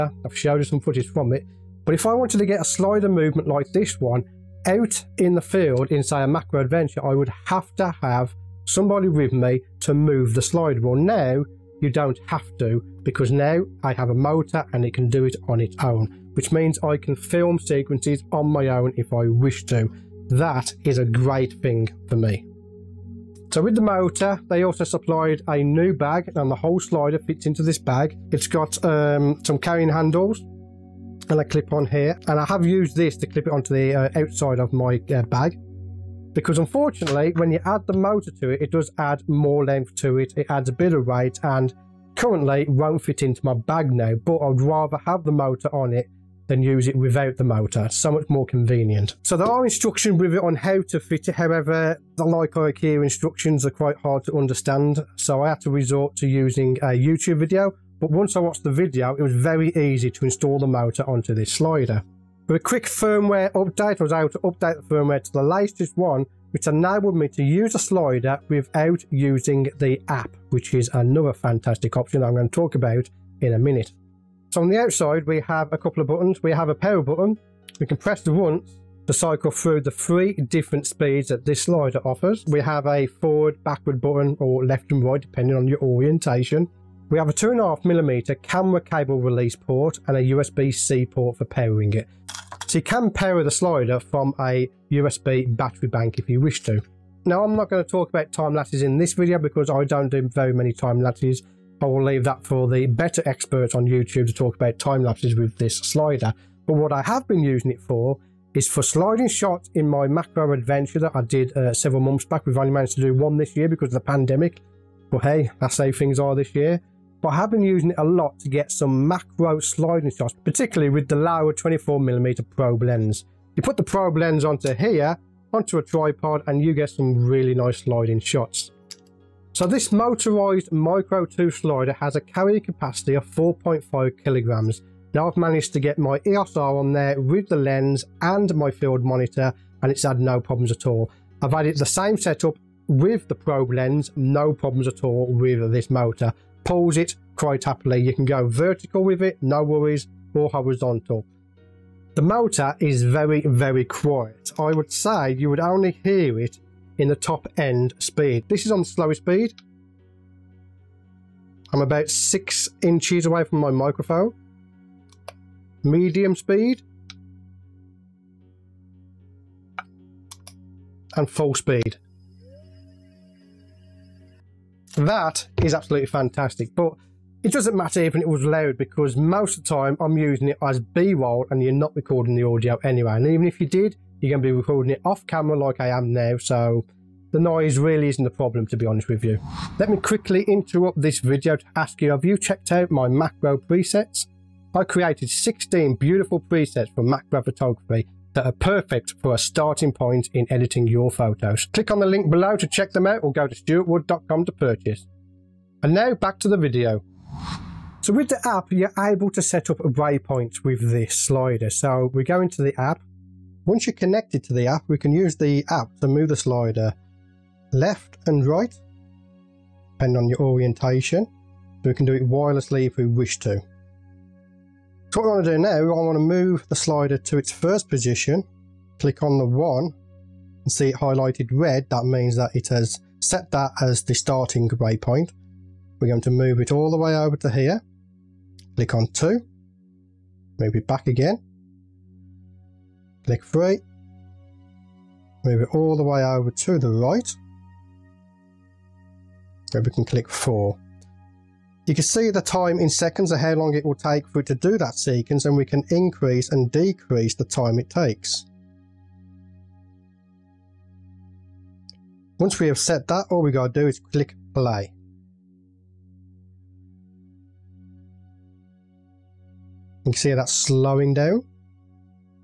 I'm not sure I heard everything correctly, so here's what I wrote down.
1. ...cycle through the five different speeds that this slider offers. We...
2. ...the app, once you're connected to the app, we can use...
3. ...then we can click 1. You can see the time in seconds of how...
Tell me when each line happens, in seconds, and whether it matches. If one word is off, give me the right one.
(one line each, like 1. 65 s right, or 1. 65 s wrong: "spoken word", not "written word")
1. 79 s wrong: "three", not "five"
2. 212 s right
3. 249 s wrong: "4", not "1".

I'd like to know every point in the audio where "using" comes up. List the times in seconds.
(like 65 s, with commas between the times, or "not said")
56 s, 69 s, 107 s, 117 s, 180 s.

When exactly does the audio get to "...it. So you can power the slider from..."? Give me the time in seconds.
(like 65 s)
91 s.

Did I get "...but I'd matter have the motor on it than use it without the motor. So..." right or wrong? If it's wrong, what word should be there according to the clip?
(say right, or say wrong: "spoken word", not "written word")
wrong: "rather", not "matter".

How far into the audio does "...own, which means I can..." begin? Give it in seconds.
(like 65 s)
15 s.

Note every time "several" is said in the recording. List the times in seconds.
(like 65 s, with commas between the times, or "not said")
111 s.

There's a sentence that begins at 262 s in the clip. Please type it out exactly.
Once we have set that, all we gotta do is click play.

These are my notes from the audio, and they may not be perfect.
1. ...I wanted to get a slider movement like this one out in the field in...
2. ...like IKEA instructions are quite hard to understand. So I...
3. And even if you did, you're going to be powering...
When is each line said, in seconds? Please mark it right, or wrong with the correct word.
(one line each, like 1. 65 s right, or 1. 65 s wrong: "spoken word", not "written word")
1. 2 s right
2. 52 s right
3. 183 s wrong: "recording", not "powering".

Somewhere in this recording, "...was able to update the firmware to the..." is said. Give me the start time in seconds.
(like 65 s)
64 s.